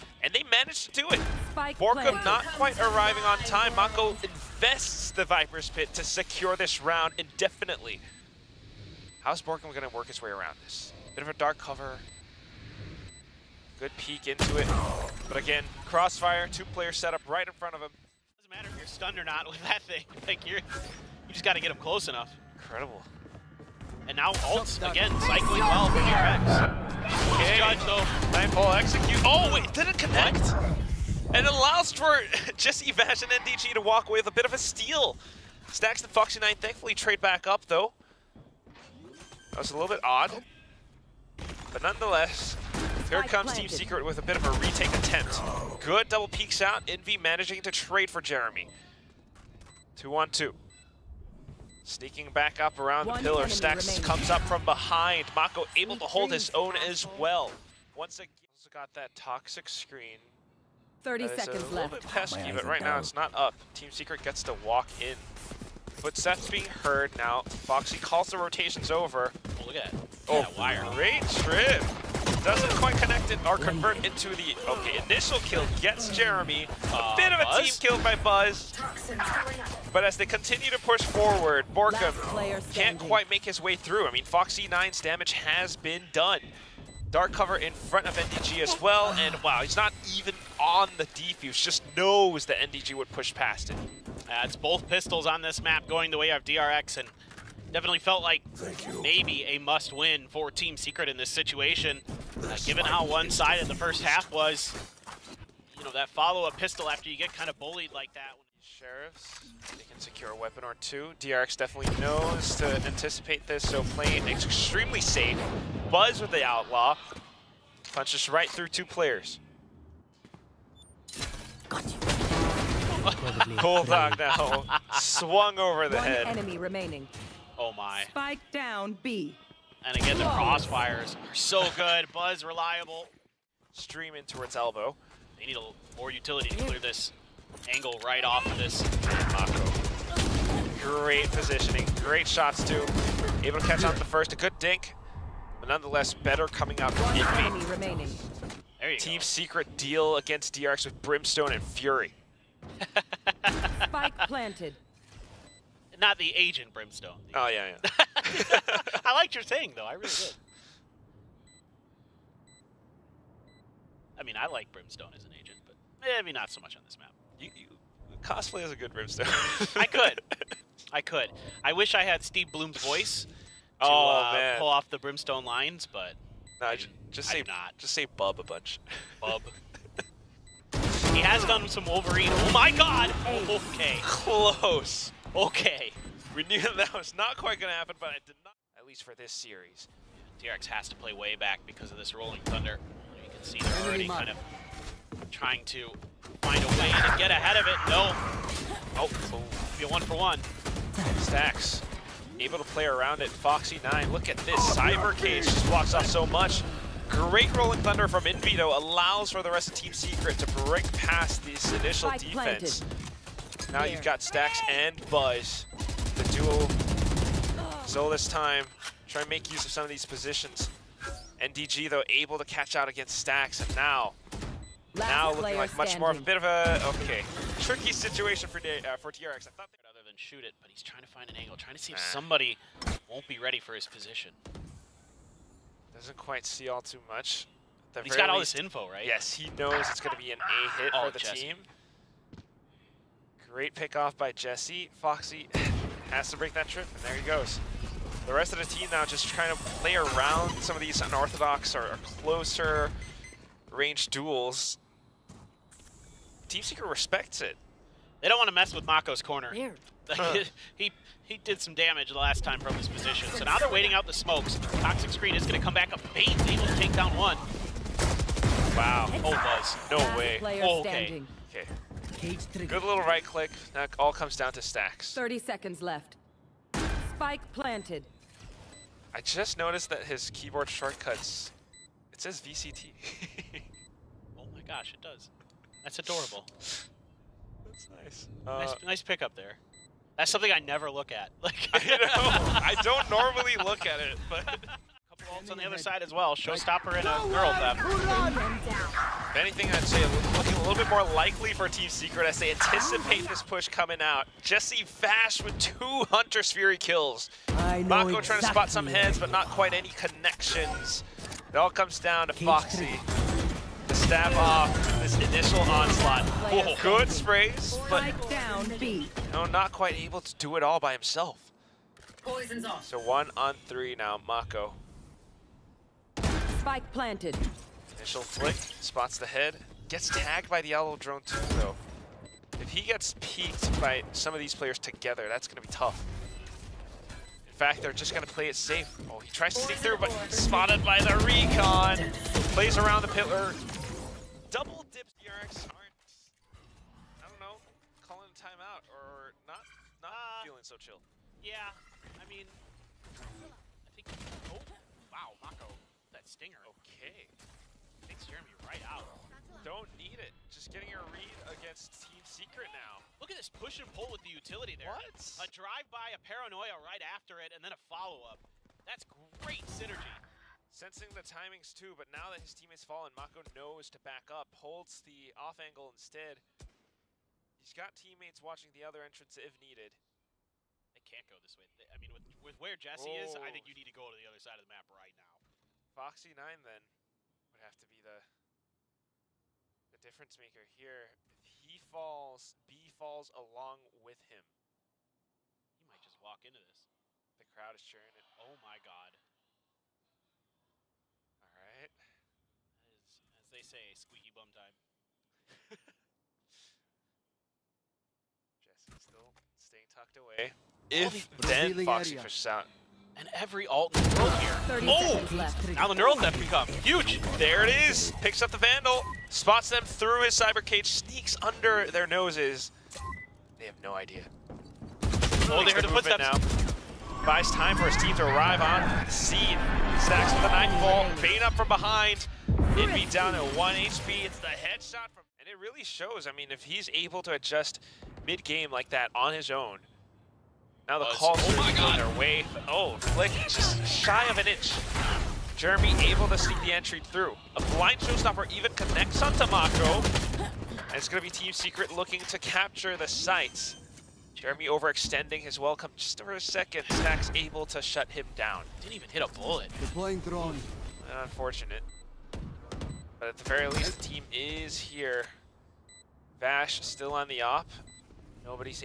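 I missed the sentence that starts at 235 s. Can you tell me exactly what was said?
Doesn't quite see all too much.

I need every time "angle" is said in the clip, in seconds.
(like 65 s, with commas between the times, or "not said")
137 s, 231 s, 375 s.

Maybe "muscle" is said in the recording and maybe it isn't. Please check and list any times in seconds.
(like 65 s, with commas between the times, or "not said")
not said.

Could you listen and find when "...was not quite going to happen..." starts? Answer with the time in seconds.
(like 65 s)
186 s.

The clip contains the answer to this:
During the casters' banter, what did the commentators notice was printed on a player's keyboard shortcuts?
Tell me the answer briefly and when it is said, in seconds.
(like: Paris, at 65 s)
VCT, at 282 s.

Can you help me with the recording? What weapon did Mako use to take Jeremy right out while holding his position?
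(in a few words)
stinger.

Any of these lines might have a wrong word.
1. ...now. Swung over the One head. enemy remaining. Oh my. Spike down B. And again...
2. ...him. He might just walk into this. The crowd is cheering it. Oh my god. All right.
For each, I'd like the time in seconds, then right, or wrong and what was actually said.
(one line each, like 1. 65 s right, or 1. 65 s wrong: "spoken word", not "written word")
1. 124 s right
2. 394 s right.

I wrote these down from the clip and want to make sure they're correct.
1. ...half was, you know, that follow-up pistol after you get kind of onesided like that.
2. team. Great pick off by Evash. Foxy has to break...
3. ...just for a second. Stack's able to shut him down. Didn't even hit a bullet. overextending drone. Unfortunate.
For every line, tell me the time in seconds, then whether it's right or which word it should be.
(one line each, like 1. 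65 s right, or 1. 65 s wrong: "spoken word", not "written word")
1. 104 s wrong: "bullied", not "onesided"
2. 241 s wrong: "Jesse", not "Evash"
3. 455 s wrong: "playing", not "overextending".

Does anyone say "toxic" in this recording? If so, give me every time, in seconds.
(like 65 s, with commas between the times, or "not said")
59 s, 264 s.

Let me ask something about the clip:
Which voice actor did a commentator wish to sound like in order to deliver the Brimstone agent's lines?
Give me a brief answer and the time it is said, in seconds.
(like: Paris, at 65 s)
Steve Blum, at 172 s.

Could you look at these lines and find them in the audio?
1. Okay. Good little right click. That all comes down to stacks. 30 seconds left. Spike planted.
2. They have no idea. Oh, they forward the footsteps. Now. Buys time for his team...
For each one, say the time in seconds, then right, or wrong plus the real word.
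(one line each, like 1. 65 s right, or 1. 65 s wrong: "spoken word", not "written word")
1. 271 s right
2. 423 s wrong: "heard", not "forward".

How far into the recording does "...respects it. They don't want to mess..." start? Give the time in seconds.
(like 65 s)
256 s.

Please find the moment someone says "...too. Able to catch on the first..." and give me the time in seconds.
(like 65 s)
142 s.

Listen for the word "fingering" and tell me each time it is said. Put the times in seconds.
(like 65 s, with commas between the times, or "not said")
not said.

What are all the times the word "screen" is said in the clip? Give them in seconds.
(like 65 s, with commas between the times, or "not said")
59 s, 265 s.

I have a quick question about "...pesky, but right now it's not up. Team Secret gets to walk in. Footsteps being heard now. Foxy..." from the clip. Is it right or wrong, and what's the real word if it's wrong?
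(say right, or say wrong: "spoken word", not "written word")
right.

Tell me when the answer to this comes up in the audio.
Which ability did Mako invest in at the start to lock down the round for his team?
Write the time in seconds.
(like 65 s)
5 s.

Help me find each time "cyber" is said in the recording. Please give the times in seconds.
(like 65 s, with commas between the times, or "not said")
204 s, 420 s.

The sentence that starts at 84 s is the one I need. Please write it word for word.
I mean, Foxy 9's damage has been done.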